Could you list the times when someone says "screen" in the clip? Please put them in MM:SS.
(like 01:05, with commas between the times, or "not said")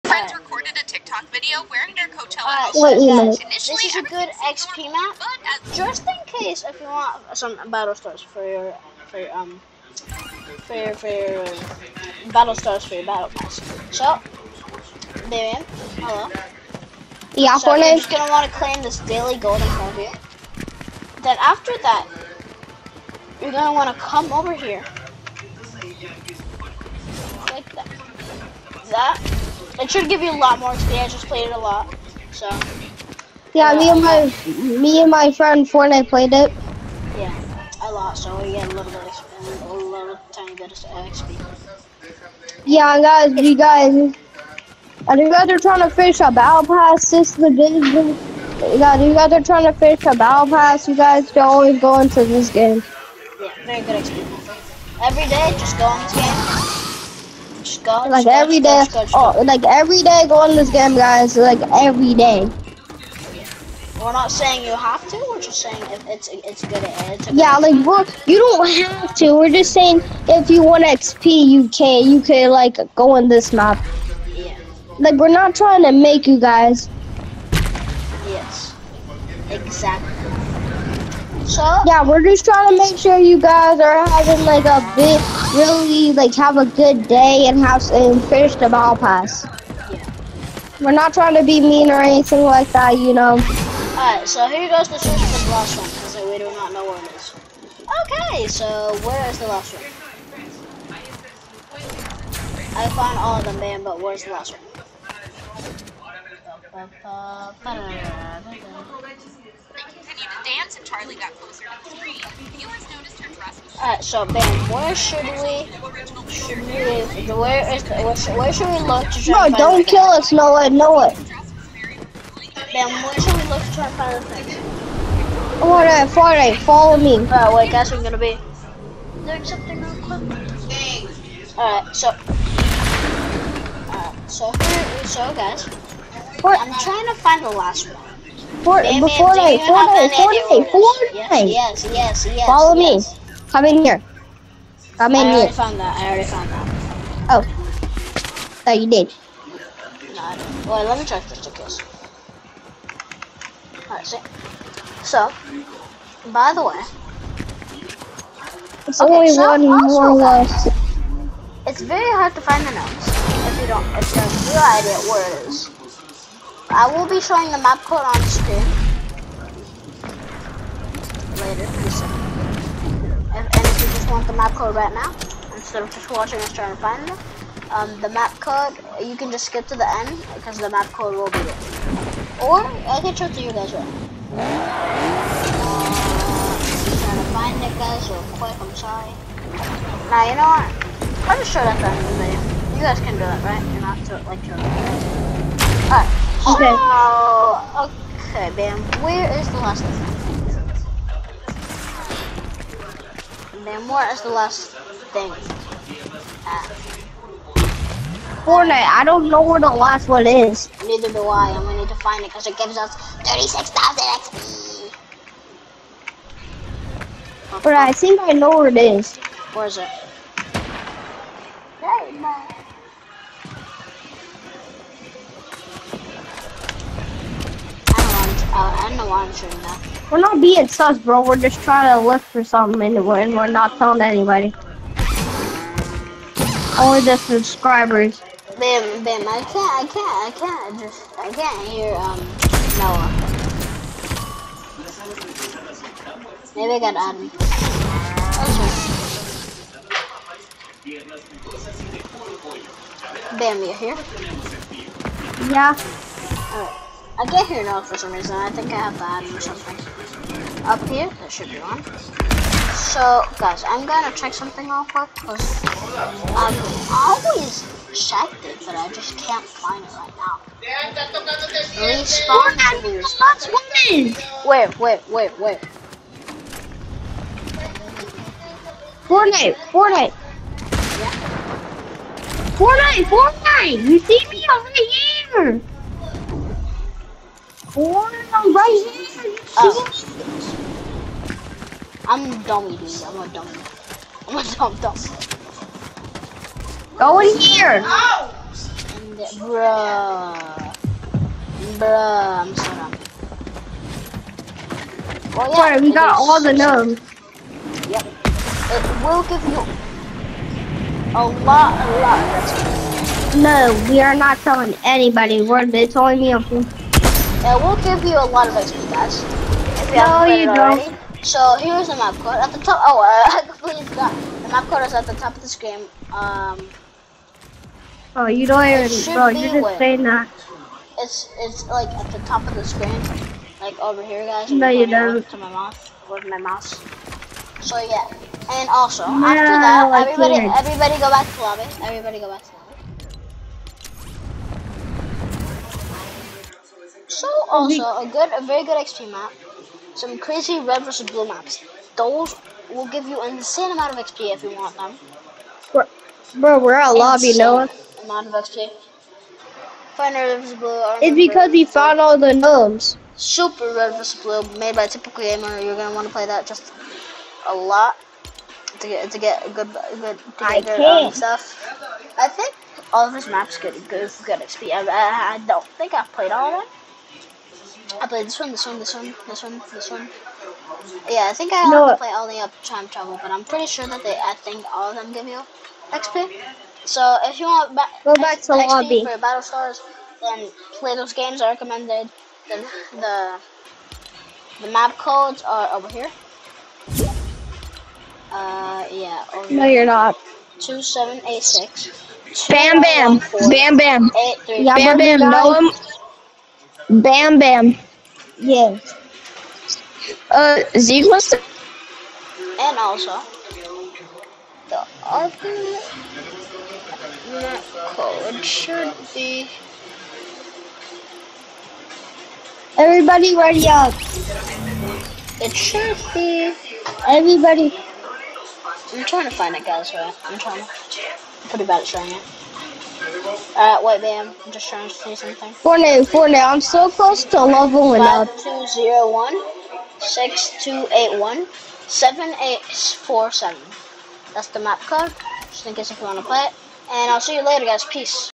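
02:48, 05:32.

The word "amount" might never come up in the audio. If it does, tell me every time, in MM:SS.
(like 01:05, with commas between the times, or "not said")
05:53, 05:58.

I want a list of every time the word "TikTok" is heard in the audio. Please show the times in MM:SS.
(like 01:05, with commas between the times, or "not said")
00:01.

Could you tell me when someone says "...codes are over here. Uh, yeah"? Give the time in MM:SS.
06:34.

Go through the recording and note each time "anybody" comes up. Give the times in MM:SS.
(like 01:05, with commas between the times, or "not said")
03:54, 05:14.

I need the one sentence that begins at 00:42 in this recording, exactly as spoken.
Yeah, guys, you guys, and you guys are trying to fish a battle pass.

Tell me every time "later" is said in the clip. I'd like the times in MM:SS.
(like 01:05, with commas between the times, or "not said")
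02:52, 07:27.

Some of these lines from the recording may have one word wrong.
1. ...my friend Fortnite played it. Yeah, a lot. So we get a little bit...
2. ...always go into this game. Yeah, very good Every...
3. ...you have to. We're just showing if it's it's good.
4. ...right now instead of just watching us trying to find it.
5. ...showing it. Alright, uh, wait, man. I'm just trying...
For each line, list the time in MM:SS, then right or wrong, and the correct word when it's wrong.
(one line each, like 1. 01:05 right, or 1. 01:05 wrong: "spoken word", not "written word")
1. 00:35 right
2. 00:51 right
3. 01:04 wrong: "saying", not "showing"
4. 02:54 right
5. 07:11 right.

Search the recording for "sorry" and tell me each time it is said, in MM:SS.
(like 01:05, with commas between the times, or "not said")
03:08, 05:05.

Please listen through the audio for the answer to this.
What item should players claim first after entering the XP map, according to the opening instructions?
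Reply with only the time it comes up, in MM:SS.
00:18.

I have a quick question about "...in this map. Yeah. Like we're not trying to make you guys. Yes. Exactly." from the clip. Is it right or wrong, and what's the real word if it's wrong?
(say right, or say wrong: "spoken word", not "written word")
right.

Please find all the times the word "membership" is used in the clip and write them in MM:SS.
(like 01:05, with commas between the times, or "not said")
not said.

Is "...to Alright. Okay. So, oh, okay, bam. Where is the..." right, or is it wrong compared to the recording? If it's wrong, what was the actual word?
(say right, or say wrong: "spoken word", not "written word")
right.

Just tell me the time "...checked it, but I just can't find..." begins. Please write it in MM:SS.
04:27.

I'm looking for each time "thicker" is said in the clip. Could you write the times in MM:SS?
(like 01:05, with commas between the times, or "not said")
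not said.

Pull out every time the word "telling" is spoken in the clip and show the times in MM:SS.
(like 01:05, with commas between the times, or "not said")
03:53, 05:14.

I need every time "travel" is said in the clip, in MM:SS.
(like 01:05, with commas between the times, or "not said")
06:22.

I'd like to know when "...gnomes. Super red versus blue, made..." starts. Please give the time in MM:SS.
06:02.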